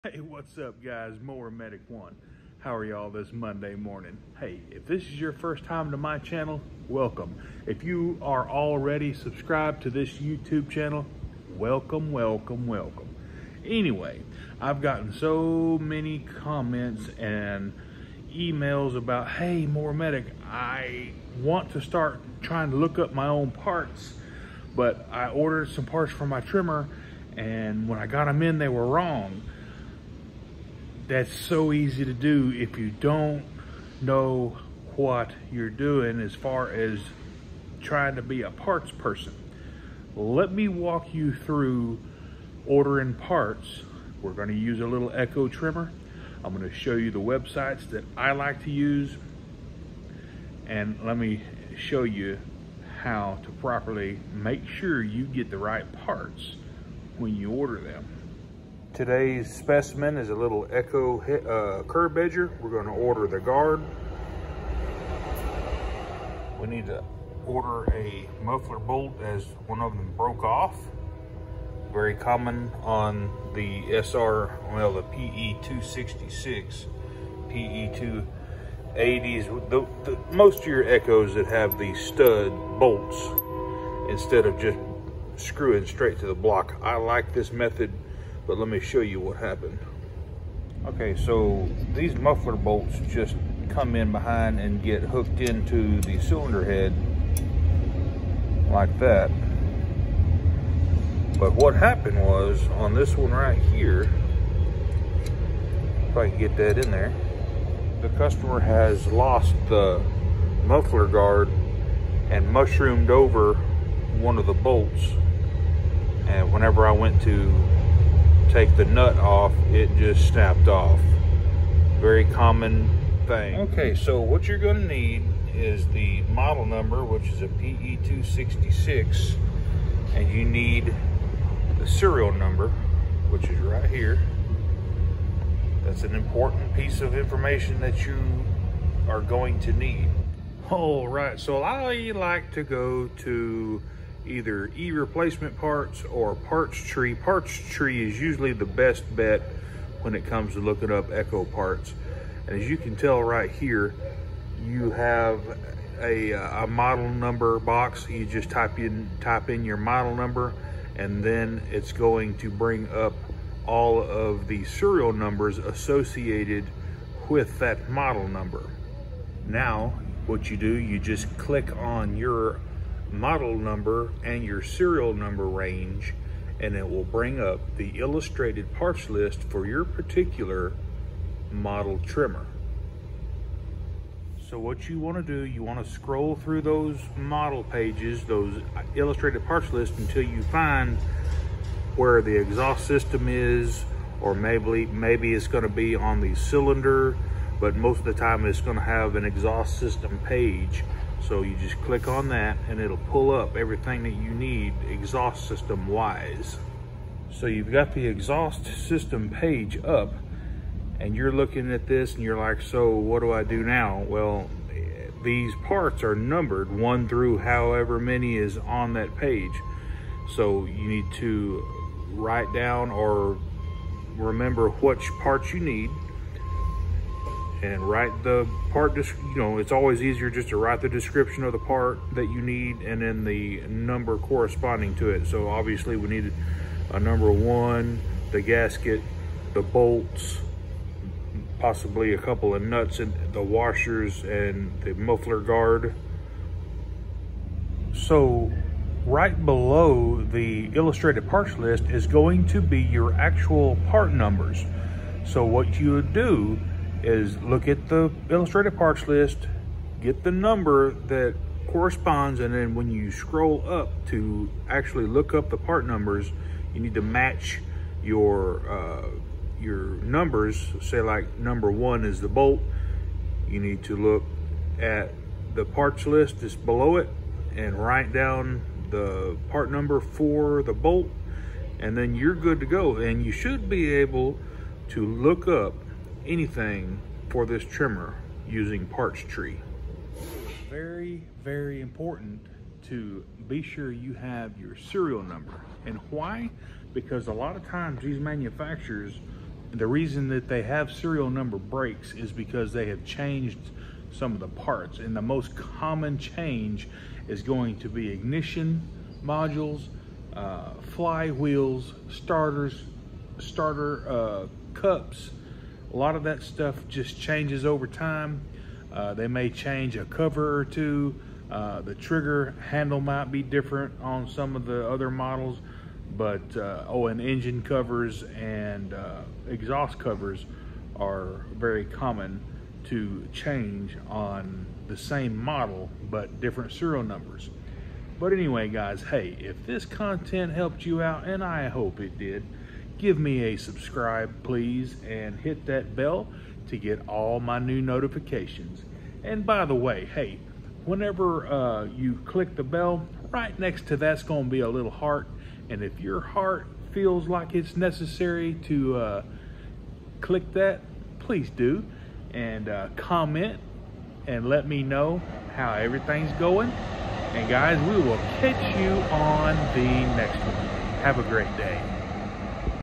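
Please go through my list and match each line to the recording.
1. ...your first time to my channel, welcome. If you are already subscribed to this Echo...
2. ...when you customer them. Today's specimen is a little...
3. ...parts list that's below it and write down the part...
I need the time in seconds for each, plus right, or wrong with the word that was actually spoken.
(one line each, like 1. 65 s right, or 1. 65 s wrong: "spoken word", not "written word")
1. 5 s wrong: "YouTube", not "Echo"
2. 57 s wrong: "order", not "customer"
3. 275 s right.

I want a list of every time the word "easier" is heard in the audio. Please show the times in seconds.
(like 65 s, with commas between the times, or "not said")
230 s.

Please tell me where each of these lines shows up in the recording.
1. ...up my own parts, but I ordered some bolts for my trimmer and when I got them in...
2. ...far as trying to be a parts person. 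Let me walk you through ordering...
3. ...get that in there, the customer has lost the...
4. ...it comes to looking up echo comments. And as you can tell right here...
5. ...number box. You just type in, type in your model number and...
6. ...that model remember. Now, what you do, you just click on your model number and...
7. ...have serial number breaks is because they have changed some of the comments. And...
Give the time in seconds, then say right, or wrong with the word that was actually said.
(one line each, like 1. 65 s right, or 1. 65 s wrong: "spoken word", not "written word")
1. 22 s wrong: "parts", not "bolts"
2. 36 s right
3. 106 s right
4. 150 s wrong: "parts", not "comments"
5. 157 s right
6. 167 s wrong: "number", not "remember"
7. 300 s wrong: "parts", not "comments".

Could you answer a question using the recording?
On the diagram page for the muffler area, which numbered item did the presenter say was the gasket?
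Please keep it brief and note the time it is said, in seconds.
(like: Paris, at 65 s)
Number 1, at 236 s.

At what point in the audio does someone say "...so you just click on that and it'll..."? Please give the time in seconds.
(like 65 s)
201 s.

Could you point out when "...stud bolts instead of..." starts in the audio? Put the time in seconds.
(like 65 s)
81 s.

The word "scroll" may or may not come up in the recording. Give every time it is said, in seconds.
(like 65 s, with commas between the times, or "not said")
185 s, 263 s.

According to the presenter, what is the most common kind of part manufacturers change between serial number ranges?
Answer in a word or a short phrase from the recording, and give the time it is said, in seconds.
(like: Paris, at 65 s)
Ignition modules, at 308 s.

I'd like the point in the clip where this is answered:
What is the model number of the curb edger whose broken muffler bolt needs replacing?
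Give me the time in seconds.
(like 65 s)
127 s.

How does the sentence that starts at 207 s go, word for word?
So you've got the exhaust system page up and you're looking at this and you're like, so what do I do now?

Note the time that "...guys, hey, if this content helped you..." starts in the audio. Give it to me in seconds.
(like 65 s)
338 s.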